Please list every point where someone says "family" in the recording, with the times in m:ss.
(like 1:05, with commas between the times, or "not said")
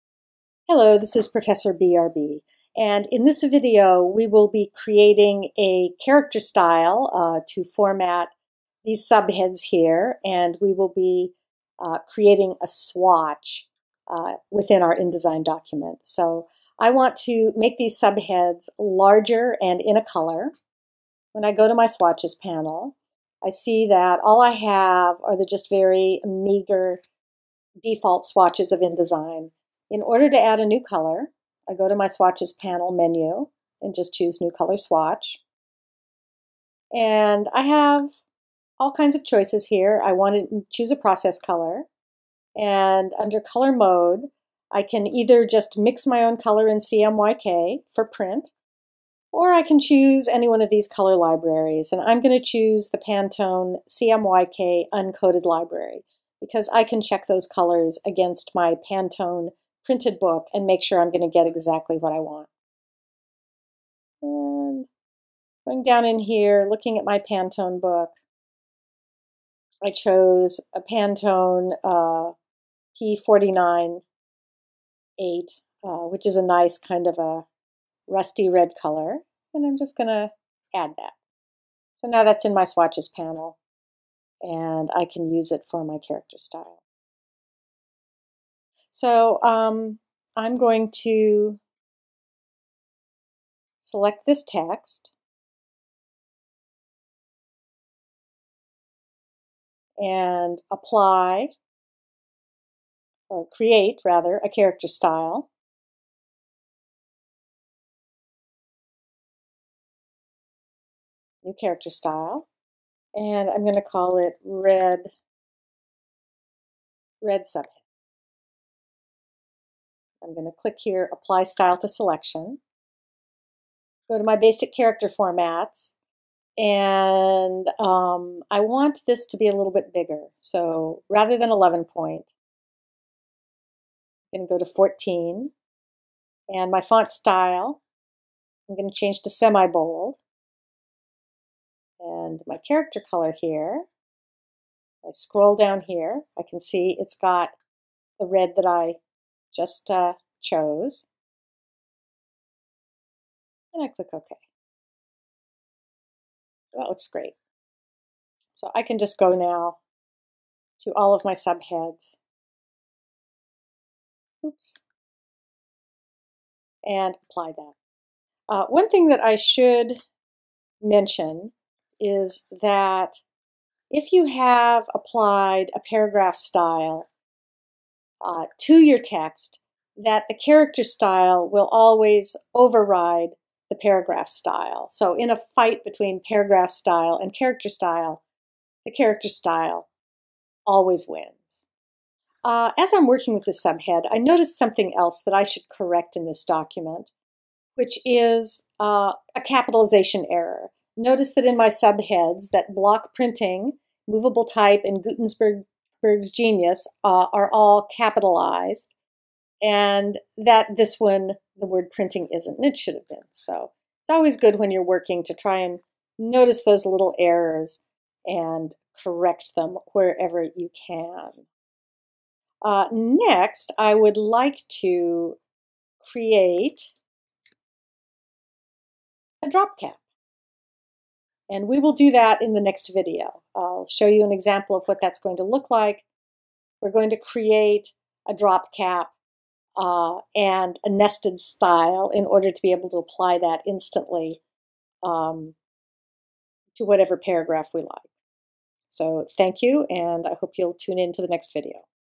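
not said.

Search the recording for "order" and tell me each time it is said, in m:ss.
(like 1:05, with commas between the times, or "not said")
0:30, 4:02.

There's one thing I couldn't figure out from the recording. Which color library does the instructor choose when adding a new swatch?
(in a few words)
Pantone CMYK Uncoded.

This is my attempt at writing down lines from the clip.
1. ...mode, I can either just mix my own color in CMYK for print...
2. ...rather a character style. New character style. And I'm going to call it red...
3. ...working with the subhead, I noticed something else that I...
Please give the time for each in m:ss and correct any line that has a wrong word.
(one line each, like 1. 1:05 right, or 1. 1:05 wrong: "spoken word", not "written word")
1. 0:43 right
2. 1:44 right
3. 3:13 right.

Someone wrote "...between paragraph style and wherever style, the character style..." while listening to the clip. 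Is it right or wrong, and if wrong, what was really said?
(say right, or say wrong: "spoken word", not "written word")
wrong: "character", not "wherever".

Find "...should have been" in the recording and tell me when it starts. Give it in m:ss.
3:32.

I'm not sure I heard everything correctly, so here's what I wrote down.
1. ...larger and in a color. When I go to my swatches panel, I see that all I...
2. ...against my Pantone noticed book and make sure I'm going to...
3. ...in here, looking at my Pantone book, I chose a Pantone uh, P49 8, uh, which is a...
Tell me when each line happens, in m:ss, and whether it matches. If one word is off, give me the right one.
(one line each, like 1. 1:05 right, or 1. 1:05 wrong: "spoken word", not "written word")
1. 0:18 right
2. 0:58 wrong: "printed", not "noticed"
3. 1:06 right.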